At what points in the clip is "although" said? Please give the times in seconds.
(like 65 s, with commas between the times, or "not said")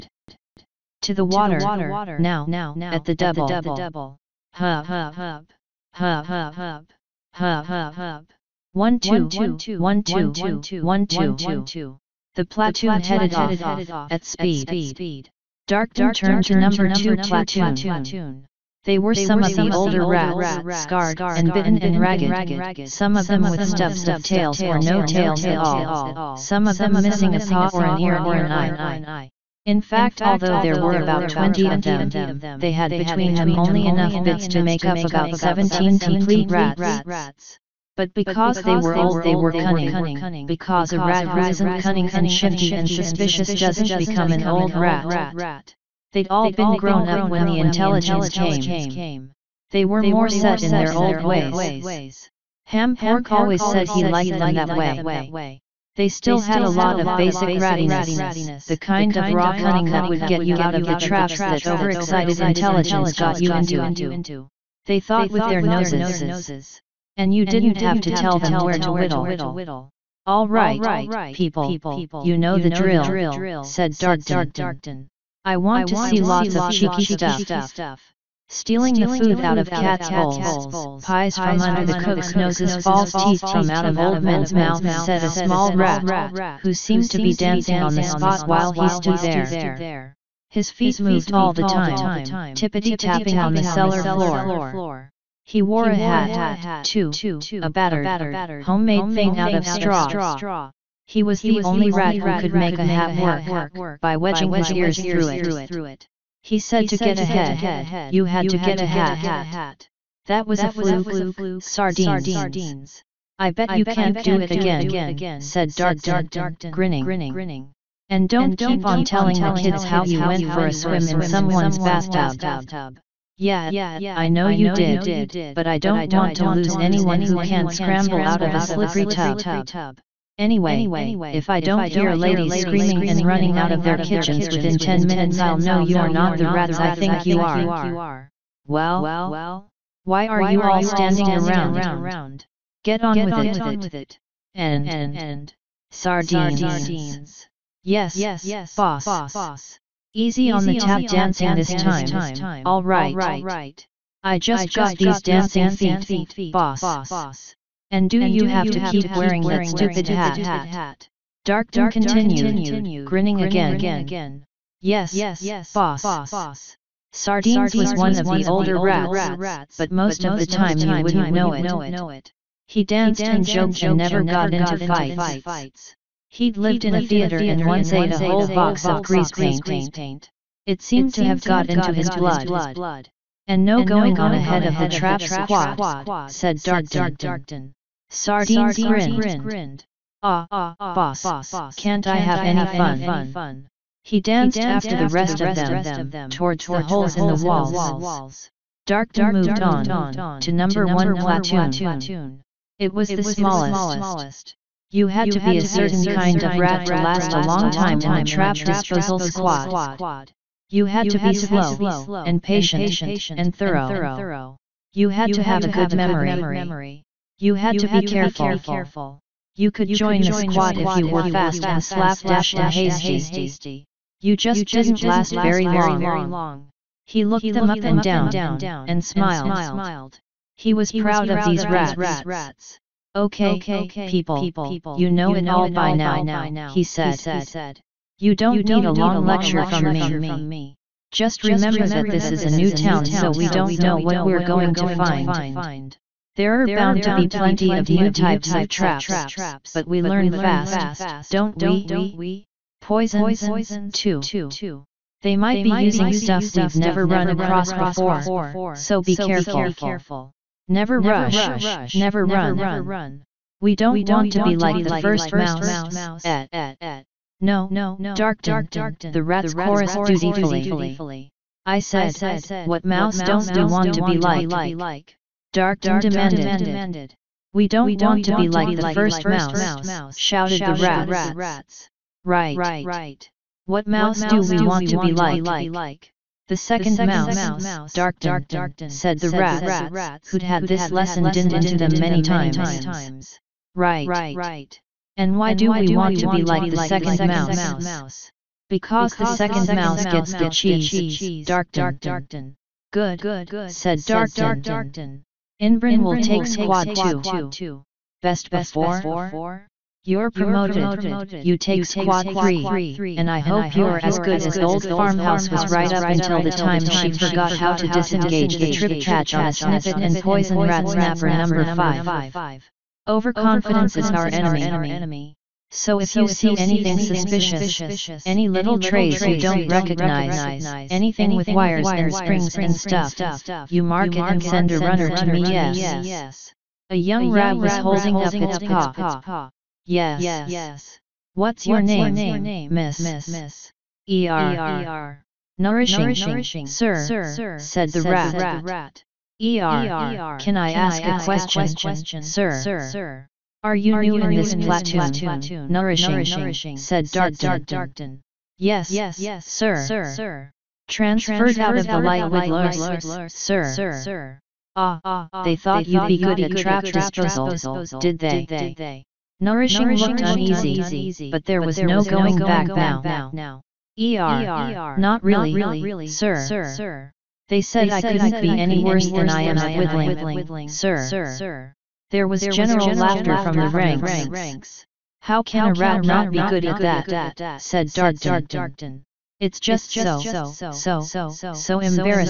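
30 s.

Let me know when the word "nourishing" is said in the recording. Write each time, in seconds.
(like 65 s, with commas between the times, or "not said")
345 s, 355 s, 369 s.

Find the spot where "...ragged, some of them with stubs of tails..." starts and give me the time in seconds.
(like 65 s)
21 s.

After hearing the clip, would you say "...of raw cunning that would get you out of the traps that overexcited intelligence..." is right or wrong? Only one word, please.
right.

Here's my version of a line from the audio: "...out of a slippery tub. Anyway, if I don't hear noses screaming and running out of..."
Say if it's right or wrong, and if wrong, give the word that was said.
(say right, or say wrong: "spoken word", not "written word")
wrong: "ladies", not "noses".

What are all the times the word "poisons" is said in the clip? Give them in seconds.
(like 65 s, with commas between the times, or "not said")
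252 s, 320 s.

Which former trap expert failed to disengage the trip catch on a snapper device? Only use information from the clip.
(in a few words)
Farmhouse.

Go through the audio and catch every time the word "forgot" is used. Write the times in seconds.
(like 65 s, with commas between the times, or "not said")
317 s.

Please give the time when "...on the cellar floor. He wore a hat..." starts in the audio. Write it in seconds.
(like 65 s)
93 s.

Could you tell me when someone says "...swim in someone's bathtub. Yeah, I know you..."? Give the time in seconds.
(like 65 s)
120 s.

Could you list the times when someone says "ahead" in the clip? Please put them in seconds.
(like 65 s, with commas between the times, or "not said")
107 s, 184 s.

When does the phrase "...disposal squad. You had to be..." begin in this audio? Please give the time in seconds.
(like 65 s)
208 s.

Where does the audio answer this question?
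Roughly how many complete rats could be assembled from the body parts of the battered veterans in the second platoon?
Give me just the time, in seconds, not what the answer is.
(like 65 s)
35 s.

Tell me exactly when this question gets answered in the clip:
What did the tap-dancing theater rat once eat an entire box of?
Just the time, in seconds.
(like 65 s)
179 s.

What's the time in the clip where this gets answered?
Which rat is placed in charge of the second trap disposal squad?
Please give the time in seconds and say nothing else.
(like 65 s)
305 s.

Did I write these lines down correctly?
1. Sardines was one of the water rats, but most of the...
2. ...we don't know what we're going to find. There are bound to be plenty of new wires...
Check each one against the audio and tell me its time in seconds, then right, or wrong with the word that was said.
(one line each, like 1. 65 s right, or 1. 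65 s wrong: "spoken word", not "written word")
1. 167 s wrong: "older", not "water"
2. 243 s wrong: "types", not "wires".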